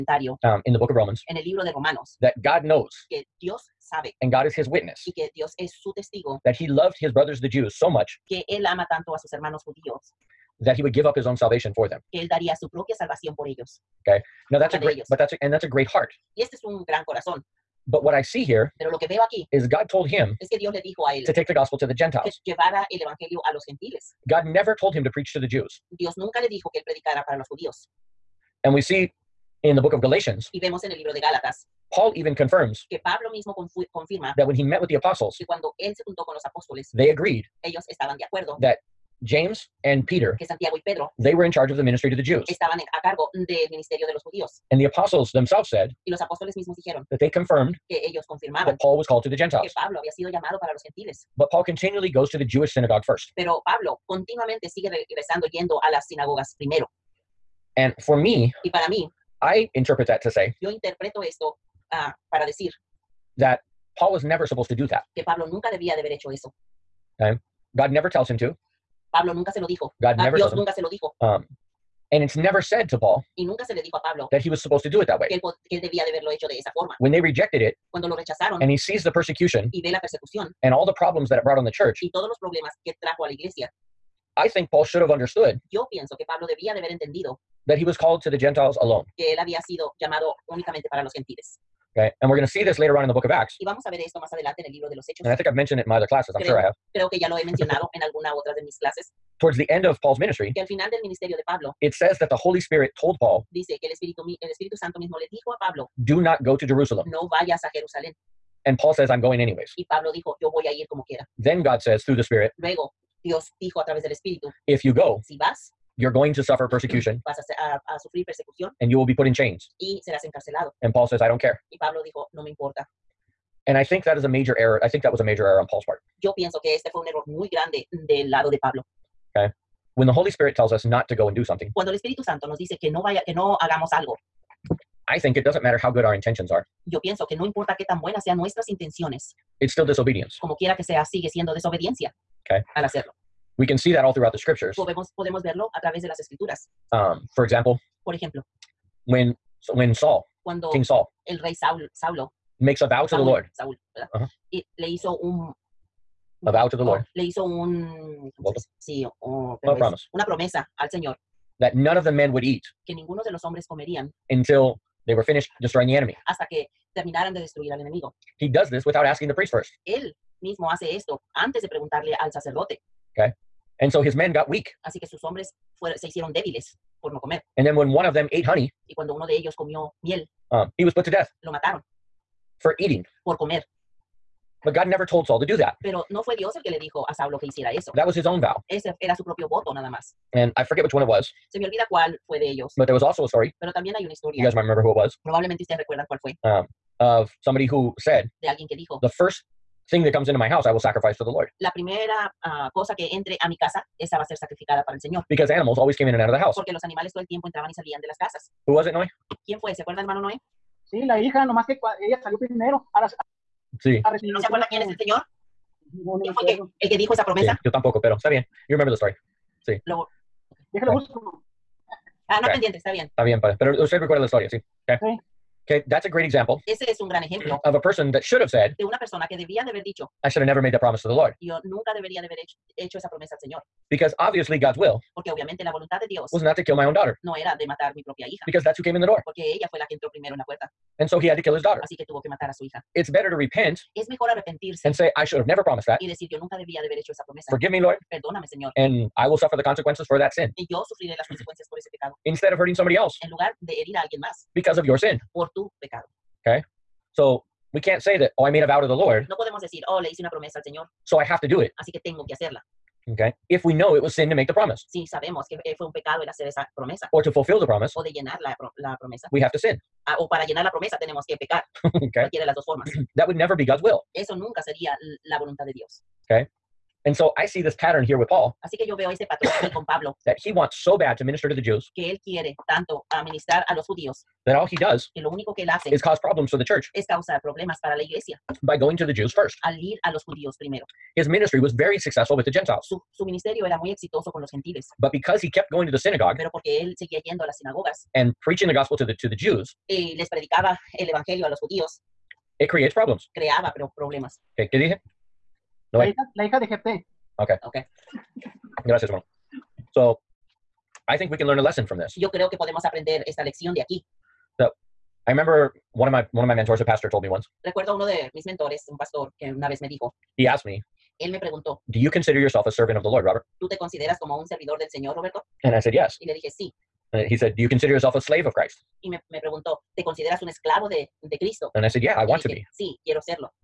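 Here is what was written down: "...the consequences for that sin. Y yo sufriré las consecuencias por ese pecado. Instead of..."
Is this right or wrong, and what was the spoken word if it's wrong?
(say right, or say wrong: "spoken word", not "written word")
right.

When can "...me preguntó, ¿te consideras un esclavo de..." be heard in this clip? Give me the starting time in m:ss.
5:29.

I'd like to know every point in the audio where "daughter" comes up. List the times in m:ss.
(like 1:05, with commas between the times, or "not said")
3:56, 4:01.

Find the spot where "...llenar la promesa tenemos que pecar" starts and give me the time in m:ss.
4:30.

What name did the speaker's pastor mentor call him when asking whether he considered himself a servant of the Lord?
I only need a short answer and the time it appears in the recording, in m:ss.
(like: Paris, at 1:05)
Robert, at 5:23.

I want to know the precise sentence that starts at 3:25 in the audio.
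Because animals always came in and out of the house.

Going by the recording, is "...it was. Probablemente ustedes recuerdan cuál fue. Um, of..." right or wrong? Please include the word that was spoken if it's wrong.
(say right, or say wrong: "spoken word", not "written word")
right.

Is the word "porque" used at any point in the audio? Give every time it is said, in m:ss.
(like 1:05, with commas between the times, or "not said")
3:26, 3:55, 3:59, 4:56.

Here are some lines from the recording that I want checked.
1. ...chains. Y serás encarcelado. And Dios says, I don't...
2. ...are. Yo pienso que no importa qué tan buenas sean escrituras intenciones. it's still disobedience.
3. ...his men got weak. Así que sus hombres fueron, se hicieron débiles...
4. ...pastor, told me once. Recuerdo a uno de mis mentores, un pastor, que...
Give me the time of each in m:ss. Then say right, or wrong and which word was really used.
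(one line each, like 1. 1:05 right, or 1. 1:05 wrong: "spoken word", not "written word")
1. 1:59 wrong: "Paul", not "Dios"
2. 2:16 wrong: "nuestras", not "escrituras"
3. 2:54 right
4. 5:16 right.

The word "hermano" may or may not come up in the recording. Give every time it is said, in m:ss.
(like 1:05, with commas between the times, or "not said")
0:09, 3:30, 5:09.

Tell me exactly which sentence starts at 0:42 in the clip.
Estaban a cargo del ministerio de los judíos.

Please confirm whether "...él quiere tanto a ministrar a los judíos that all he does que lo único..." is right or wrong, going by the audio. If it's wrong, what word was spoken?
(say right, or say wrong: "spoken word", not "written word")
right.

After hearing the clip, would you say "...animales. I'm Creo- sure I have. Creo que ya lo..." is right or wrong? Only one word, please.
wrong.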